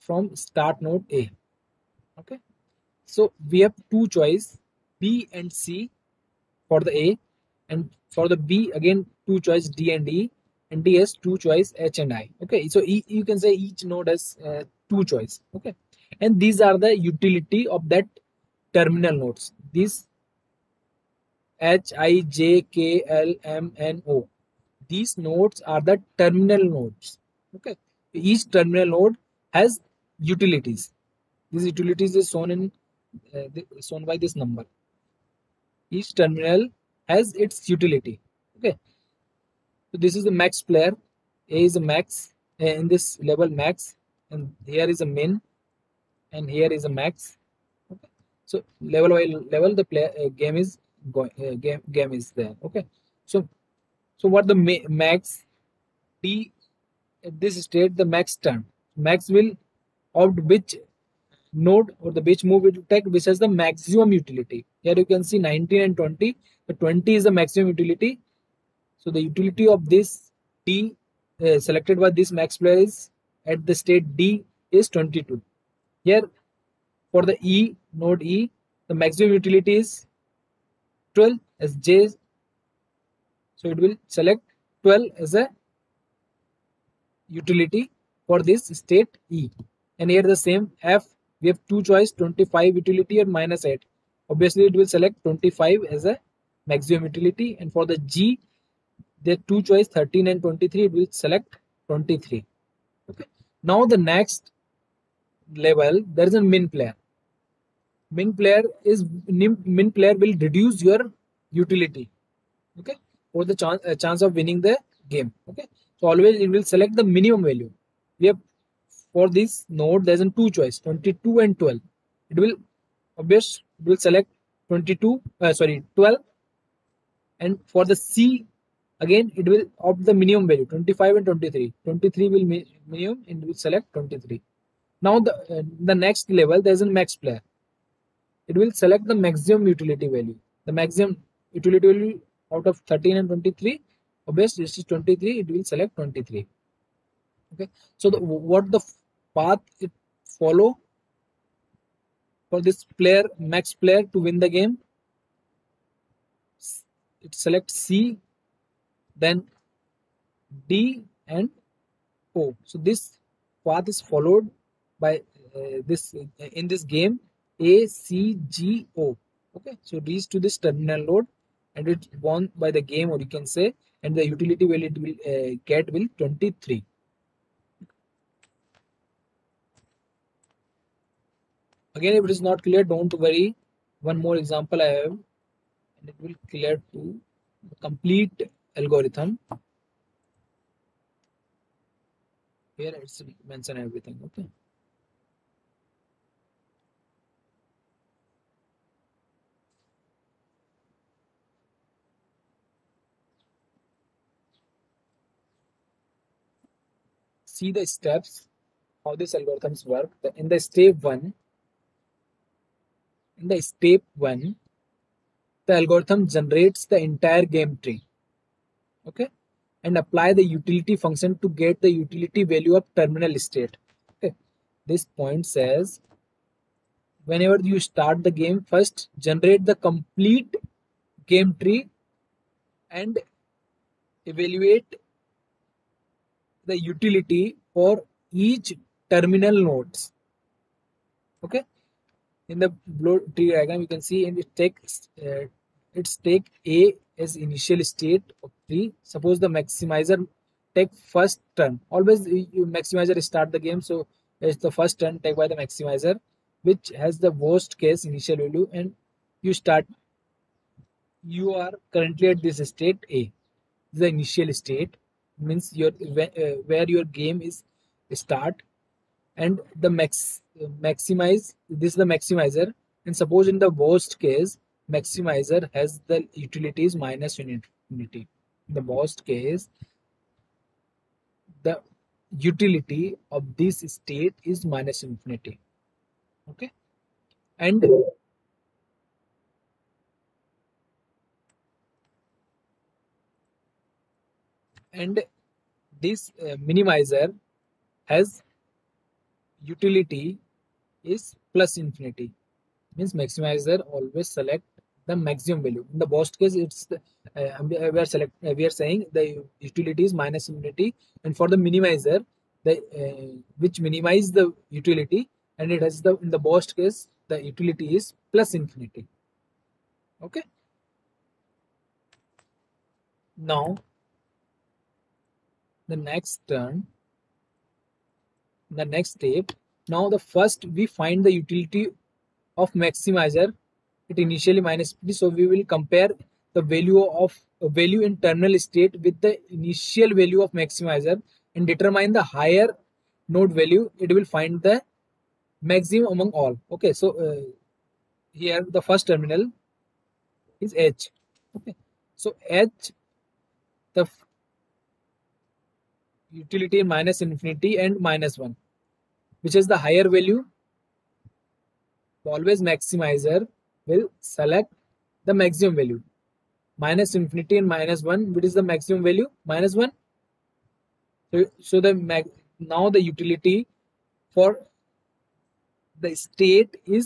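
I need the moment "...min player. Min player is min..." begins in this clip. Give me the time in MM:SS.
01:46.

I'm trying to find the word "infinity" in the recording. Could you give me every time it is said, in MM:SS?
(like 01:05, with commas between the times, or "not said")
04:45, 05:01, 05:10, 05:18, 05:57, 06:07.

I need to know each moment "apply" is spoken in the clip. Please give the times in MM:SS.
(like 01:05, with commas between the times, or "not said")
03:39.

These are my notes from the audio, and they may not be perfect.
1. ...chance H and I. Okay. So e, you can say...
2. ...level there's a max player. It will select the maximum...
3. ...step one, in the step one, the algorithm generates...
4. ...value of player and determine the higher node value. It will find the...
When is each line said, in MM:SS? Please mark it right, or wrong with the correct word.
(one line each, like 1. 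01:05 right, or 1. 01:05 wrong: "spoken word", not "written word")
1. 00:11 wrong: "choice", not "chance"
2. 02:16 right
3. 03:30 right
4. 05:40 wrong: "maximizer", not "player".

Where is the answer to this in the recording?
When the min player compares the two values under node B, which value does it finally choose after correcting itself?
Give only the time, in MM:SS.
02:05.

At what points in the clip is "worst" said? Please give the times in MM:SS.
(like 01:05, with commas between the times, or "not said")
04:17, 04:33, 04:38, 05:06, 05:16.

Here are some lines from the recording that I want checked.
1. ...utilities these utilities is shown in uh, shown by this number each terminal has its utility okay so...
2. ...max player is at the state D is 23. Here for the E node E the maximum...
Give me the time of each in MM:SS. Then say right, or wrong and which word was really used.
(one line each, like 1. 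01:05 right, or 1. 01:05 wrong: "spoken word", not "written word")
1. 00:30 right
2. 01:12 wrong: "22", not "23".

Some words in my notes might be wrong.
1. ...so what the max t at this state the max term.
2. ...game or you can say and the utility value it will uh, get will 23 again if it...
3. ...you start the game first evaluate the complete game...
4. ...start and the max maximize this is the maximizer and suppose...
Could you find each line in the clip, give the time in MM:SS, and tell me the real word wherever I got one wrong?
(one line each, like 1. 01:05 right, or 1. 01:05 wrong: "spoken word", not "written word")
1. 00:54 right
2. 02:52 right
3. 03:47 wrong: "generate", not "evaluate"
4. 04:28 right.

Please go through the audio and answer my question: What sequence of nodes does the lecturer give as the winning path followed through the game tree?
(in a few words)
A C G O.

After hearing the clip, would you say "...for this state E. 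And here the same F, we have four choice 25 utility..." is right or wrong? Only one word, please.
wrong.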